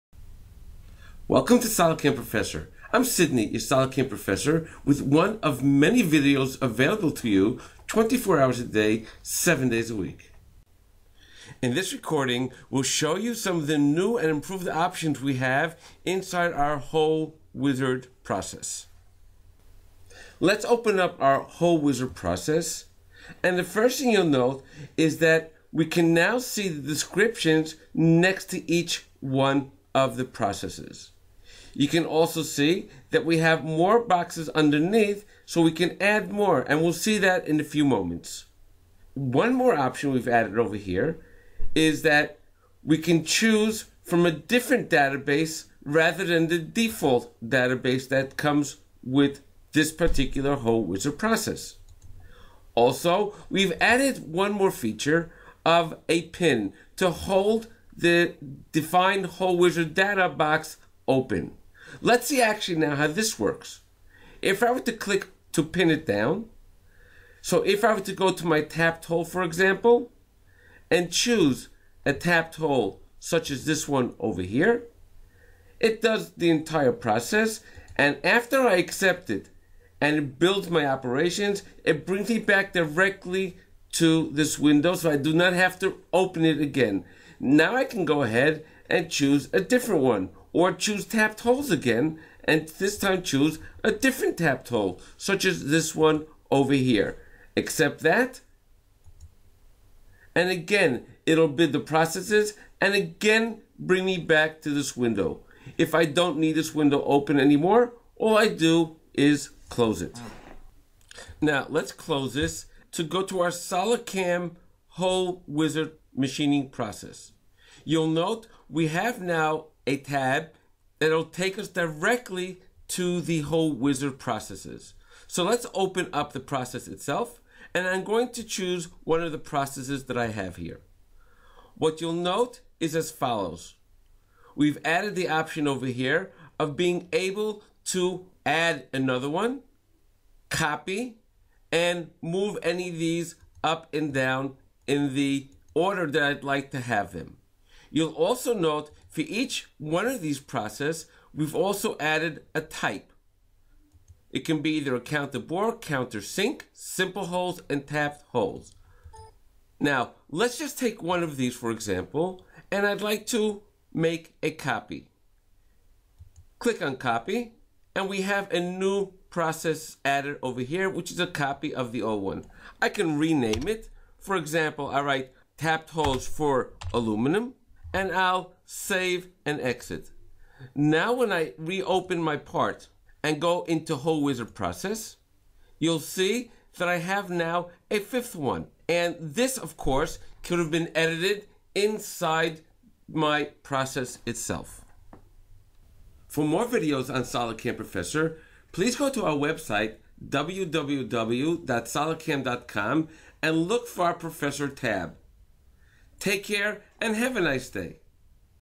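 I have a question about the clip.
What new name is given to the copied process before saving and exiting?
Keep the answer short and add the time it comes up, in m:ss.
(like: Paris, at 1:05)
tapped holes for aluminum, at 2:55.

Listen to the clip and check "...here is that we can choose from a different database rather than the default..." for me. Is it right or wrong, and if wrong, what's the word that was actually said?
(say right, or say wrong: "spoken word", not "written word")
right.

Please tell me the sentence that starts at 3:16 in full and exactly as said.
For more videos on Solidcam Professor, please go to our website, www.solidcam.com, and look for our Professor tab.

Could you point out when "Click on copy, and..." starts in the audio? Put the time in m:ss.
2:46.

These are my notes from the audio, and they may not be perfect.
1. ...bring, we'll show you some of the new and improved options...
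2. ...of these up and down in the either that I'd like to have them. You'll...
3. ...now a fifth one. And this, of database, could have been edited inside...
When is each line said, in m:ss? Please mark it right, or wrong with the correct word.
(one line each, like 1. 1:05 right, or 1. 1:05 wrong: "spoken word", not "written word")
1. 0:11 wrong: "recording", not "bring"
2. 2:22 wrong: "order", not "either"
3. 3:07 wrong: "course", not "database".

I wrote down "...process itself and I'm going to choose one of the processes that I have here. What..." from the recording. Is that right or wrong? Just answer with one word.
right.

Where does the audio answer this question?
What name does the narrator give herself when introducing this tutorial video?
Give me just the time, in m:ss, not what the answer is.
0:03.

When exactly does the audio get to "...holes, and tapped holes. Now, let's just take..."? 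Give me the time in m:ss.
2:37.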